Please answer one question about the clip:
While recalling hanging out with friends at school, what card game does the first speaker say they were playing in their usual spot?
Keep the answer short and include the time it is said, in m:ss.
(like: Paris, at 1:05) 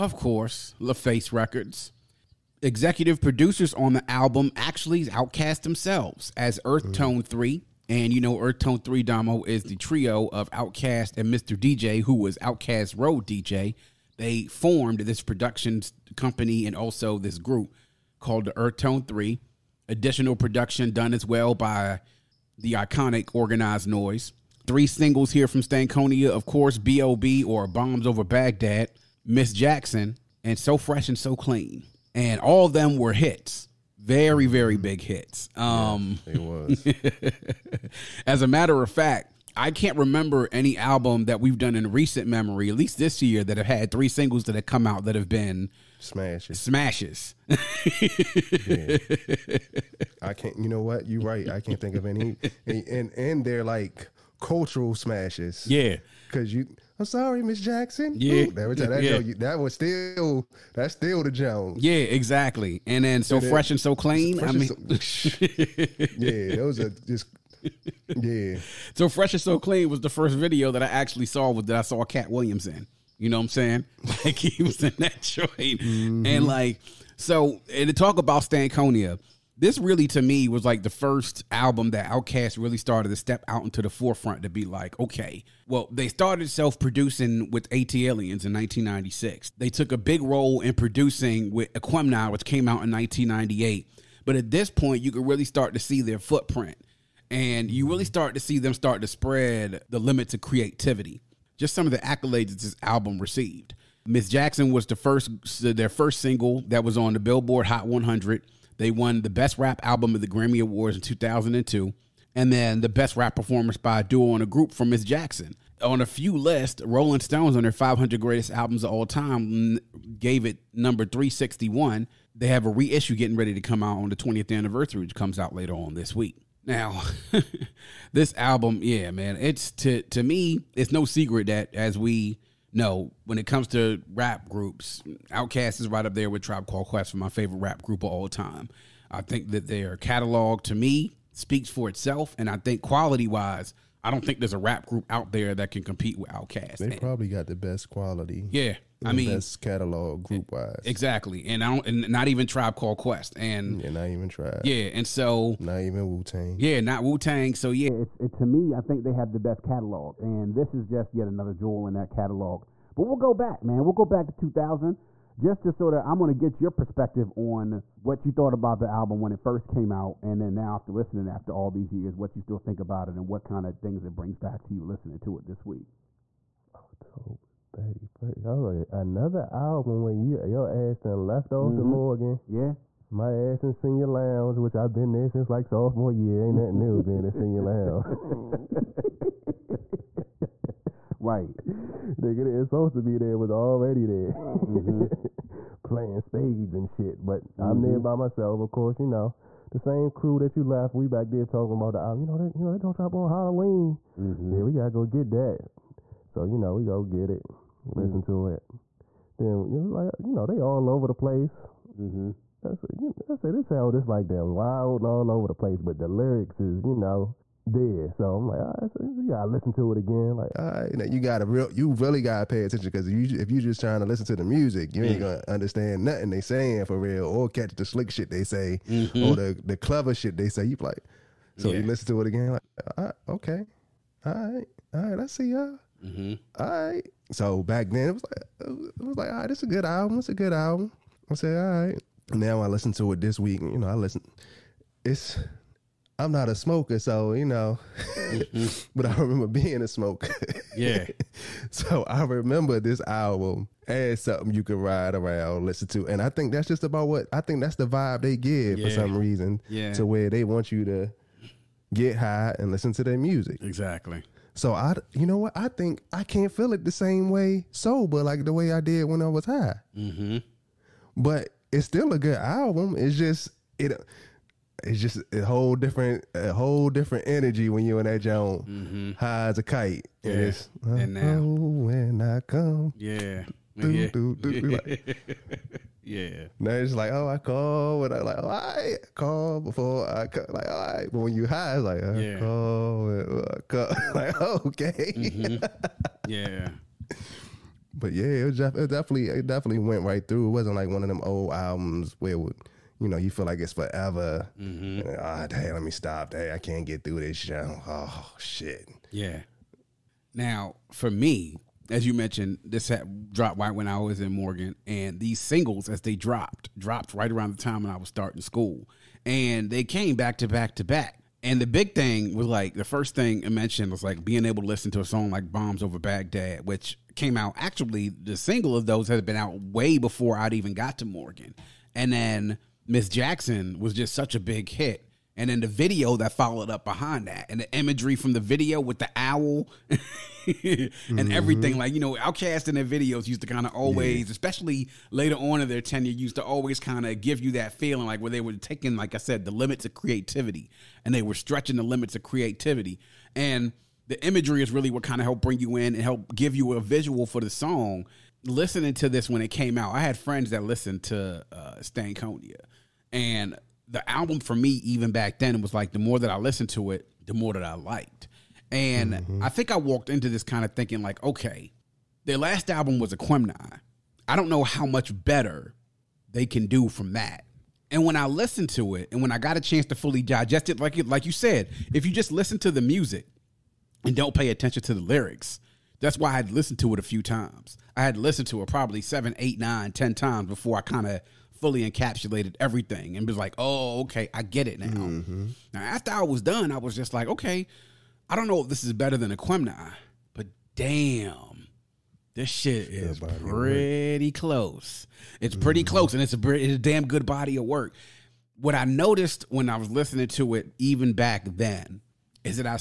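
Spades, at 3:16.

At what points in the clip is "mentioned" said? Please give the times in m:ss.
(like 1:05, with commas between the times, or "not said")
5:12, 5:23.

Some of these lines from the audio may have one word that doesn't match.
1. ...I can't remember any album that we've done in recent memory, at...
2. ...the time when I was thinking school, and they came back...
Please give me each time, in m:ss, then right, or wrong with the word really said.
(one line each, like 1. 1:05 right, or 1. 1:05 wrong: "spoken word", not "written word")
1. 0:39 right
2. 5:17 wrong: "starting", not "thinking".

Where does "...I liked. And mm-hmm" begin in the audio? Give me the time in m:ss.
6:07.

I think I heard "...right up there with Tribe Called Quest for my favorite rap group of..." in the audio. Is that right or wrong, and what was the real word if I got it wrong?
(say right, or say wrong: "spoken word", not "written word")
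right.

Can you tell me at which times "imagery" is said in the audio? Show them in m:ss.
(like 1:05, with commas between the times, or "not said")
5:37, 5:54.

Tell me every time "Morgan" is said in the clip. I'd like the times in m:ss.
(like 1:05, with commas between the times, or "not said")
3:01, 5:14, 5:31.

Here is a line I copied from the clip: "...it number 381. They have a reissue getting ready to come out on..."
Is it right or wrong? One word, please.
wrong.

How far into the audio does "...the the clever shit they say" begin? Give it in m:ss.
3:49.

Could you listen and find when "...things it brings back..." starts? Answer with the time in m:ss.
2:53.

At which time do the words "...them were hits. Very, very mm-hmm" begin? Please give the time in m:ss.
0:32.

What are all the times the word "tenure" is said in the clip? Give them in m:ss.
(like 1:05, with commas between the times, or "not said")
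5:45.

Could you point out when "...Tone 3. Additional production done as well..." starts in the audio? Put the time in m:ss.
0:18.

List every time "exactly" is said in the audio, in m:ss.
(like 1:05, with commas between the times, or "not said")
1:01, 2:30, 4:23.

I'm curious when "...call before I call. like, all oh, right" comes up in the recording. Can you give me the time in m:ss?
4:49.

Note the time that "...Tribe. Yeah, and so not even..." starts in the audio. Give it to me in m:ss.
2:34.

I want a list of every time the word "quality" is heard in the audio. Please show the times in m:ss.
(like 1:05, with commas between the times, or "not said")
2:22, 2:27.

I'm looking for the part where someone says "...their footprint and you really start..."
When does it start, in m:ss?
1:36.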